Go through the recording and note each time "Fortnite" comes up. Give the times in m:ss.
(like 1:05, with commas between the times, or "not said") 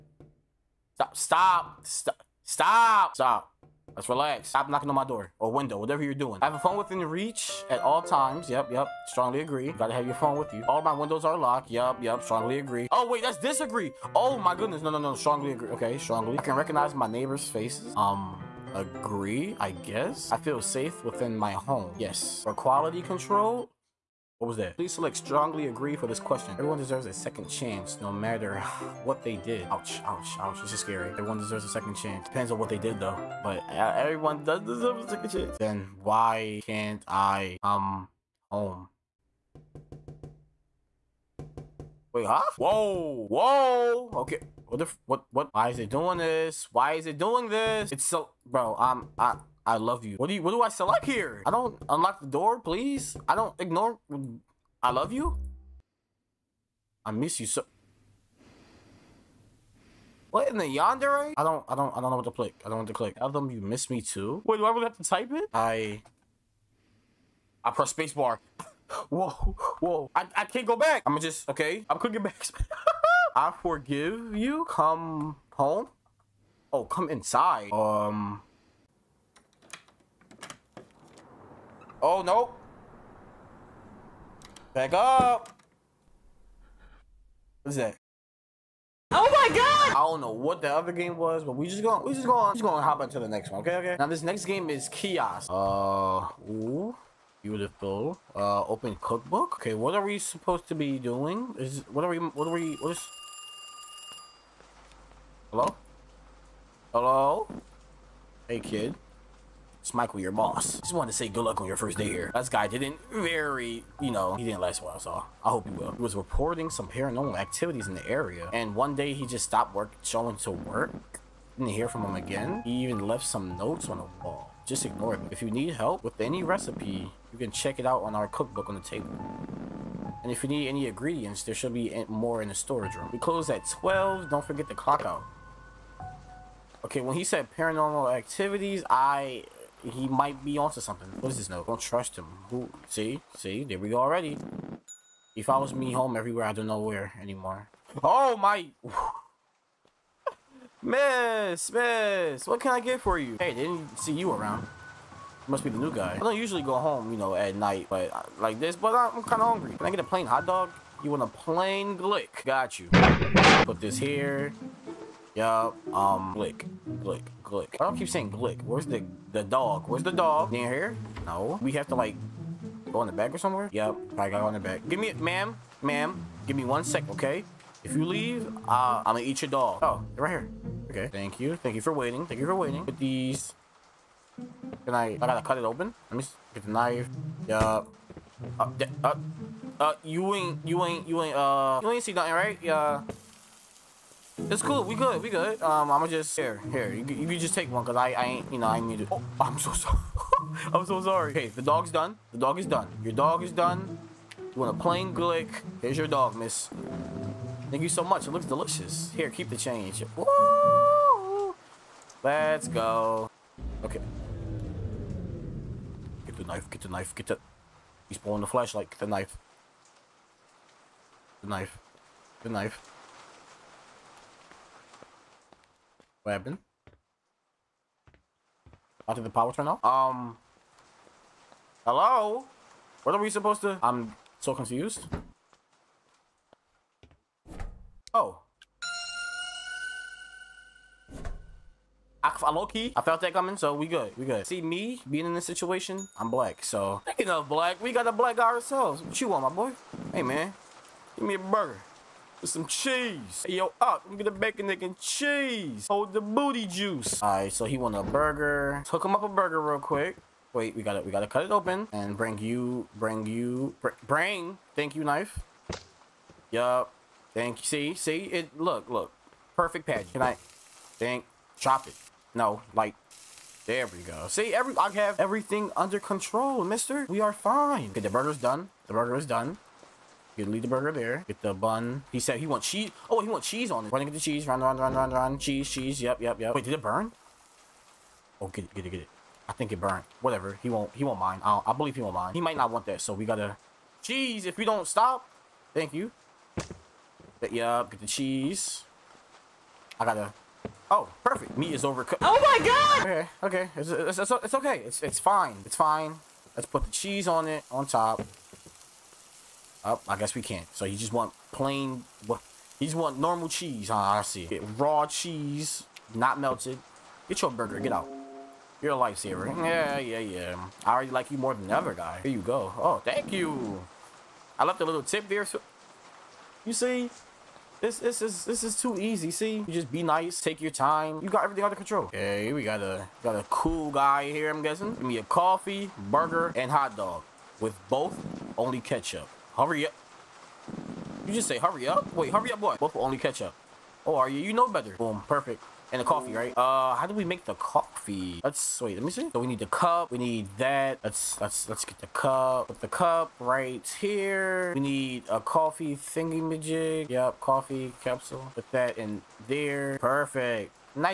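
not said.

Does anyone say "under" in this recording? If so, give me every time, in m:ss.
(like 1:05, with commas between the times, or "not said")
4:35, 5:31.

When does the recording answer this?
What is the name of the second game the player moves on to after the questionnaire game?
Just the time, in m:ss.
1:33.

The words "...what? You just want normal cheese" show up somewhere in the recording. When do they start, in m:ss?
5:12.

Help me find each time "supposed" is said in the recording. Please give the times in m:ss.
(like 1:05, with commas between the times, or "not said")
1:40, 3:53.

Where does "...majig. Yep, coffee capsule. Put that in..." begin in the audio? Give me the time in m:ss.
5:56.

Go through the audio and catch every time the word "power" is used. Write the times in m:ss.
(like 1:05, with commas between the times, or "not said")
3:49.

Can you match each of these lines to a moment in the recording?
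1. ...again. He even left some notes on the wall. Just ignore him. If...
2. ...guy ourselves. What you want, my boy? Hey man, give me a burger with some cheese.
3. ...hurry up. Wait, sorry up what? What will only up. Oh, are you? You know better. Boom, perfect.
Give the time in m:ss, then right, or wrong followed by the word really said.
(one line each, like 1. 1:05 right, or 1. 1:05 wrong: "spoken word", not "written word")
1. 2:02 right
2. 4:08 right
3. 5:41 wrong: "hurry", not "sorry".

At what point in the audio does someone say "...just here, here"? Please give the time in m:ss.
3:16.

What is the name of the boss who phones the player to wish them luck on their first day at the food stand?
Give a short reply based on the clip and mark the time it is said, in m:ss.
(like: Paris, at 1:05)
Michael, at 1:49.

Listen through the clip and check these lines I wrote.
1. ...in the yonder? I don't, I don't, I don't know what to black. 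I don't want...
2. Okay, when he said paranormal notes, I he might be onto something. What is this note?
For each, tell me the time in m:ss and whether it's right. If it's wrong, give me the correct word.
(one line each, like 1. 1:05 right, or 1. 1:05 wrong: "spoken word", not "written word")
1. 1:00 wrong: "click", not "black"
2. 2:16 wrong: "activities", not "notes".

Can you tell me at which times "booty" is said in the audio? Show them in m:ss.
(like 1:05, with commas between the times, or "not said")
4:16.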